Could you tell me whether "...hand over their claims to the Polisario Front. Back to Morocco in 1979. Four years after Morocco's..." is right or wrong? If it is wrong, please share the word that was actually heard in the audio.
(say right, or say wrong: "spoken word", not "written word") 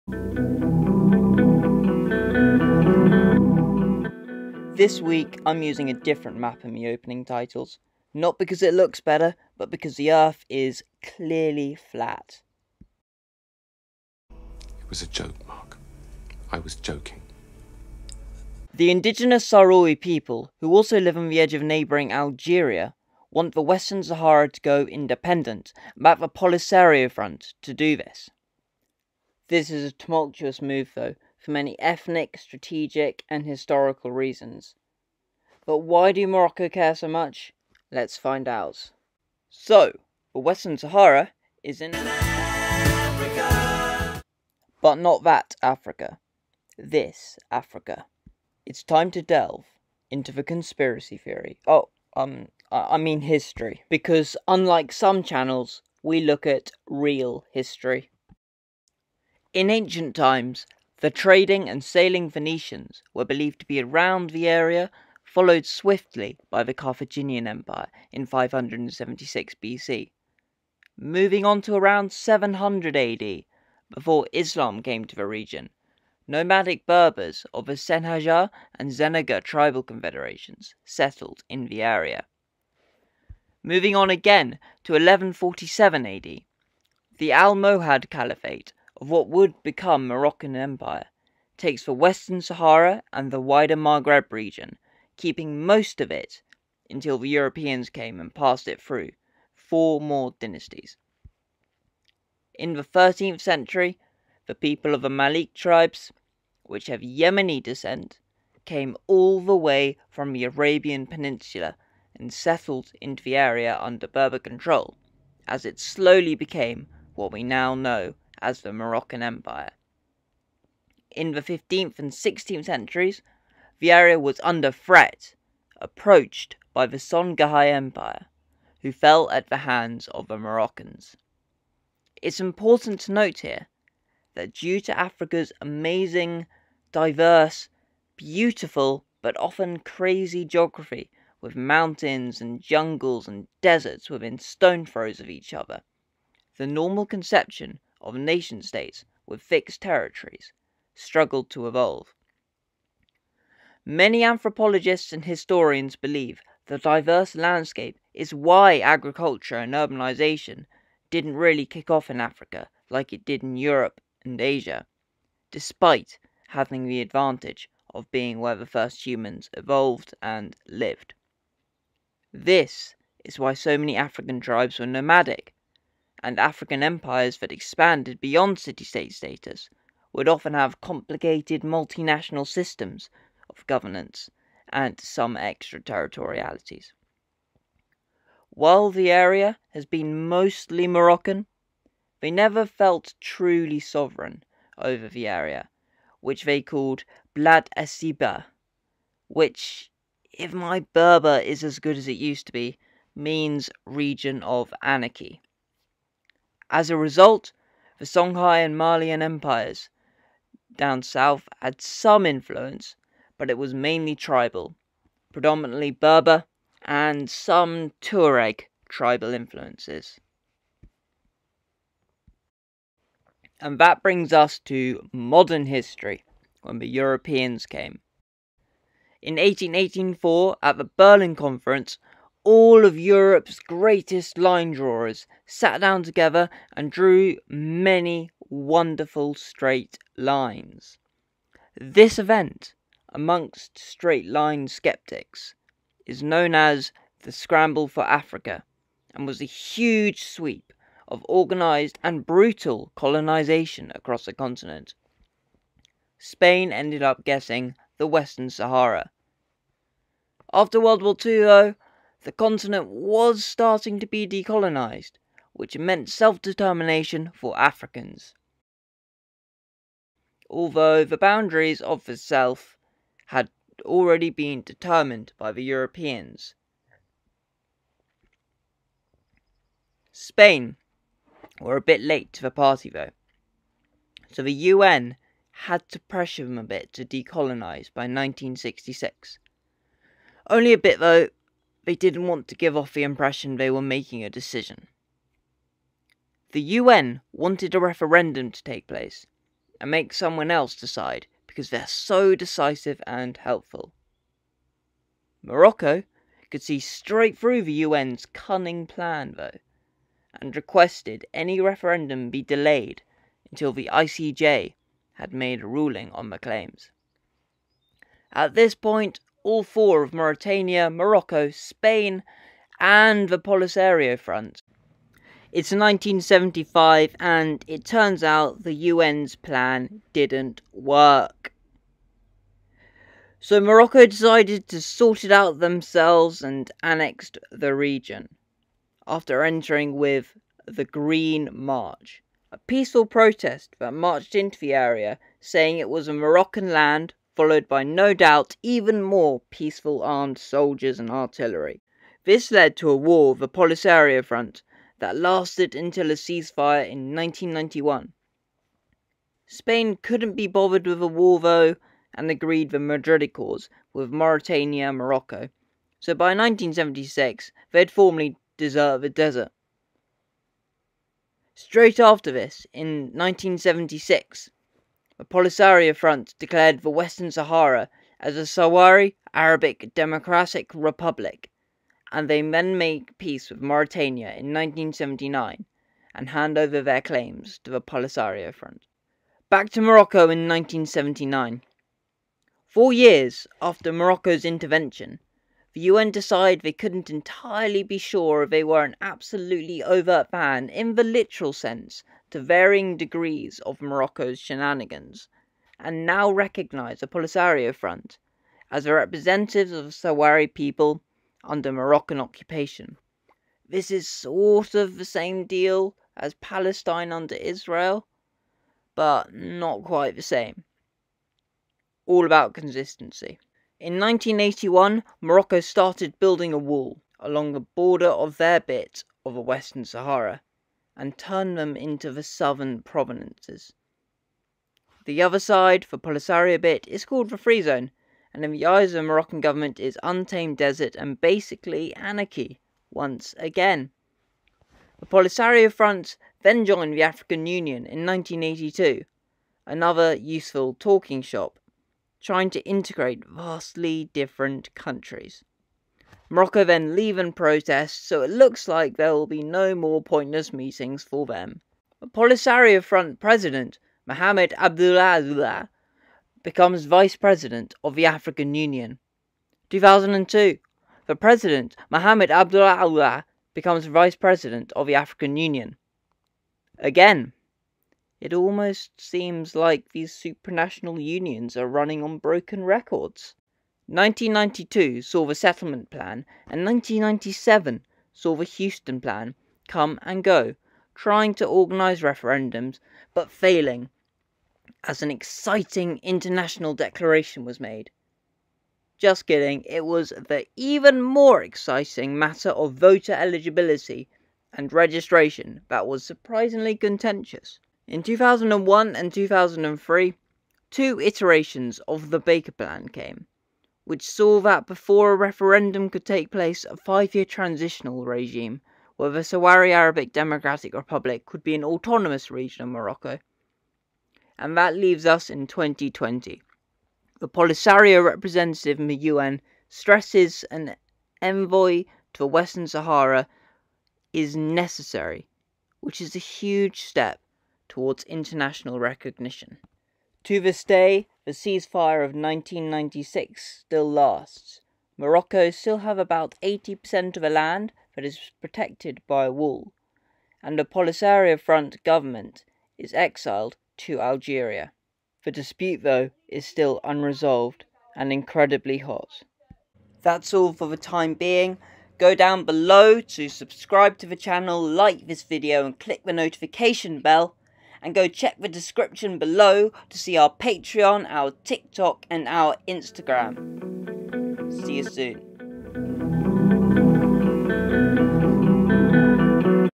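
right.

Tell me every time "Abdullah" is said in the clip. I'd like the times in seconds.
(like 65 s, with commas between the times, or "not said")
464 s, 472 s.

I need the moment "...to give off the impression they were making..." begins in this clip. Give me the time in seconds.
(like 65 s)
292 s.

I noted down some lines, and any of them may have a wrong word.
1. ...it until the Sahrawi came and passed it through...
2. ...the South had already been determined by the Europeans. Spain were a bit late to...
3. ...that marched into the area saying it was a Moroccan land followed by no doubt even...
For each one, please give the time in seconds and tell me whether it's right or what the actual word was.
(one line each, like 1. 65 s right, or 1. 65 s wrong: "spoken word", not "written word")
1. 96 s wrong: "Europeans", not "Sahrawi"
2. 272 s right
3. 343 s right.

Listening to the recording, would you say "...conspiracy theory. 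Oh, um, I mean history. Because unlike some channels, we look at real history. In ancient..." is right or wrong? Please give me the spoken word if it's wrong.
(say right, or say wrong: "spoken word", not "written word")
right.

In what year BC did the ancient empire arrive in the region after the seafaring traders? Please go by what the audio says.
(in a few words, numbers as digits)
576 BC.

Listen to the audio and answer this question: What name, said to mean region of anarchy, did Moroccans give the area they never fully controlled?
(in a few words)
Blad Asiba.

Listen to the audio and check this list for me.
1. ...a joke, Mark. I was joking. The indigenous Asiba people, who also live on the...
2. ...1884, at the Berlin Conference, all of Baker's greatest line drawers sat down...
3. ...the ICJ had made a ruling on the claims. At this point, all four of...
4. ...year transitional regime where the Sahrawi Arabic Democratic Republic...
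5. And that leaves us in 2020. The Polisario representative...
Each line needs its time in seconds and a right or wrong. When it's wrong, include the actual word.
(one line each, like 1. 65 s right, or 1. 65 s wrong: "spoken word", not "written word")
1. 15 s wrong: "Sahrawi", not "Asiba"
2. 229 s wrong: "Europe", not "Baker"
3. 313 s right
4. 517 s right
5. 524 s right.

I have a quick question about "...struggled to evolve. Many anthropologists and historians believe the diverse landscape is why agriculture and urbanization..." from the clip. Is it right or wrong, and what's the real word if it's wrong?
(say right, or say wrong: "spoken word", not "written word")
right.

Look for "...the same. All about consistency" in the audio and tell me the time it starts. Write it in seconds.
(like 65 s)
420 s.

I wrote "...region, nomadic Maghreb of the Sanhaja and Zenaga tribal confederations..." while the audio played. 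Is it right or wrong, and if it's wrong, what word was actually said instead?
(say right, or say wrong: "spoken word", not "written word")
wrong: "Berbers", not "Maghreb".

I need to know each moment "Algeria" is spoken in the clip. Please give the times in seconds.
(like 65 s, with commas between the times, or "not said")
22 s, 554 s.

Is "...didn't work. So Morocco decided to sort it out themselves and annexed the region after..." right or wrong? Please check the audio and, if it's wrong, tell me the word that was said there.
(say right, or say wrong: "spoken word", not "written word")
right.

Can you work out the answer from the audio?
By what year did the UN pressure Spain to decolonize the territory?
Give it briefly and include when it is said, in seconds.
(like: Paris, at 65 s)
1966, at 288 s.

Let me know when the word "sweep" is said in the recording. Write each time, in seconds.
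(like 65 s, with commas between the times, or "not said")
250 s.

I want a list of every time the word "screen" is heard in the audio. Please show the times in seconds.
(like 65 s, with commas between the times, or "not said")
not said.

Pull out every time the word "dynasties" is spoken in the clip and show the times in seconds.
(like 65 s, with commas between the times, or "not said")
100 s.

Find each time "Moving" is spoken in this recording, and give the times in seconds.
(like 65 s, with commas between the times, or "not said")
70 s, 83 s.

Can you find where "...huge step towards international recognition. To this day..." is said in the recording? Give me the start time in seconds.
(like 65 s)
536 s.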